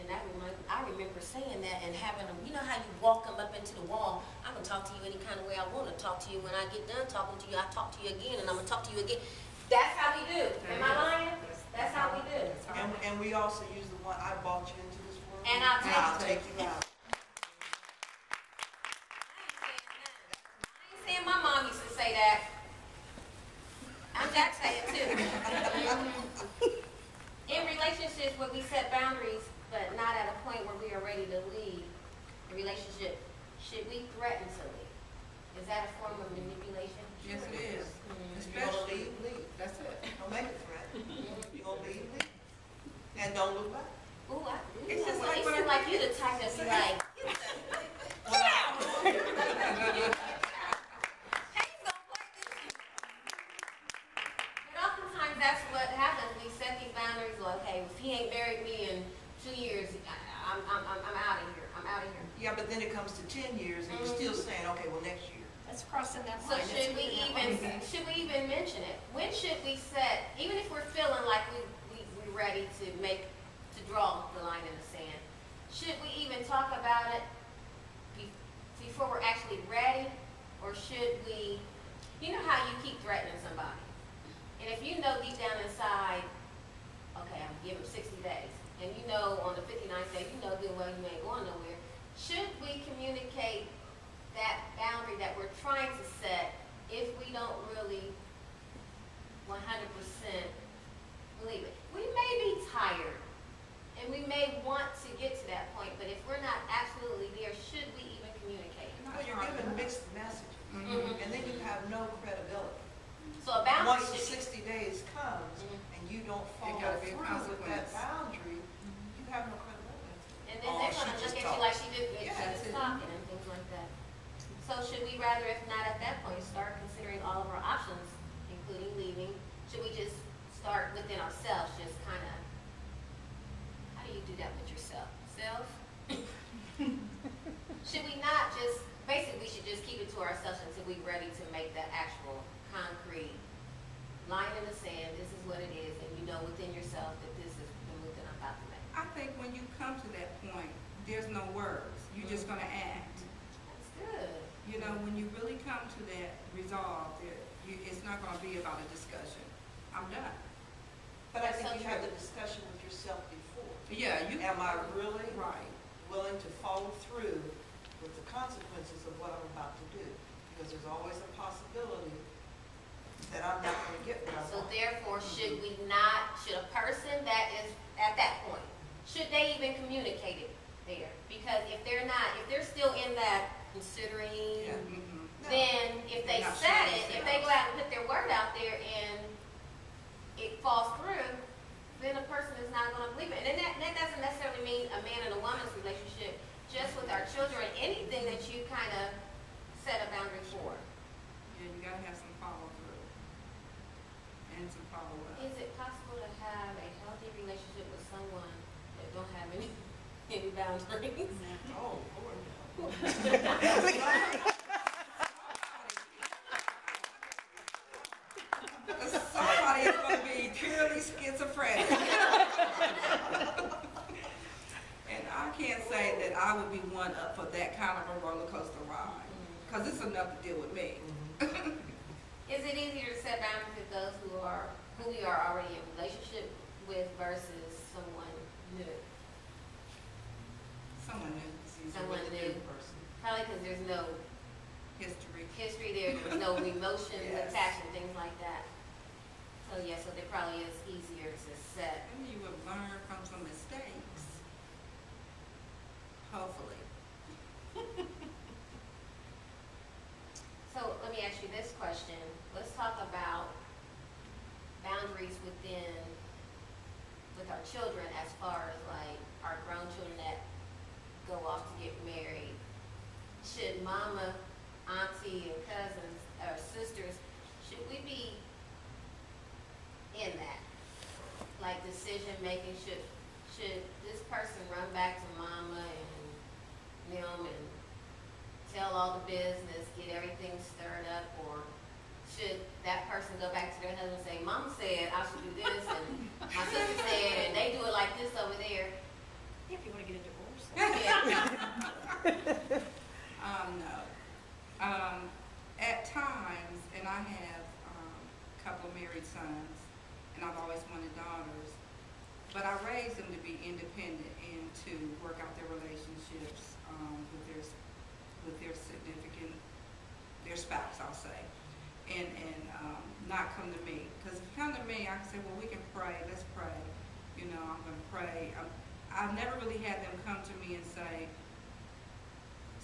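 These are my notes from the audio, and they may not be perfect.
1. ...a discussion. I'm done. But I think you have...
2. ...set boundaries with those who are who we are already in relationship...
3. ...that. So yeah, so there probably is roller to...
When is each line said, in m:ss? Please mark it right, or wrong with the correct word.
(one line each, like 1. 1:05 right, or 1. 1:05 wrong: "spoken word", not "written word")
1. 2:38 right
2. 3:53 right
3. 4:08 wrong: "easier", not "roller".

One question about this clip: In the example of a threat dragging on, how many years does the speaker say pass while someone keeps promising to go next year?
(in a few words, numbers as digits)
10.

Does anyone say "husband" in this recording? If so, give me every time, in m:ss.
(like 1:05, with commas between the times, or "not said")
4:53.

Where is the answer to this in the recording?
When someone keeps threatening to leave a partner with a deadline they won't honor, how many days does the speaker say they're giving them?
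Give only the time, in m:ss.
1:27.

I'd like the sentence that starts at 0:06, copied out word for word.
When I get done talking to you, I talk to you again and I'm going to talk to you again.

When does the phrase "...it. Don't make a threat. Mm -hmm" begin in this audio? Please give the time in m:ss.
0:39.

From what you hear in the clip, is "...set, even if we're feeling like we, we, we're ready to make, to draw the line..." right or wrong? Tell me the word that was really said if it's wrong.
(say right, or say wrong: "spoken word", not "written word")
right.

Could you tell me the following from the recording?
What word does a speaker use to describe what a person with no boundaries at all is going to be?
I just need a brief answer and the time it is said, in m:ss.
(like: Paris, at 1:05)
schizophrenic, at 3:41.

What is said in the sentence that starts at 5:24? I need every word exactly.
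Because if you come to me, I can say, well, we can pray.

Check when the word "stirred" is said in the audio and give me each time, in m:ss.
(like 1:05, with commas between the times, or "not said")
4:50.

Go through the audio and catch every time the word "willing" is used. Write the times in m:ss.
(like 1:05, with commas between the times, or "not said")
2:46.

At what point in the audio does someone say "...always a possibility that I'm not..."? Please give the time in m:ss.
2:50.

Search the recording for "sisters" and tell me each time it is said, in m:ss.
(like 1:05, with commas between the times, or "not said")
4:36, 4:56.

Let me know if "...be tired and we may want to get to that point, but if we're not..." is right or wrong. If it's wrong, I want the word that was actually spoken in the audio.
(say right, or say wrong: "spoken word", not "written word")
right.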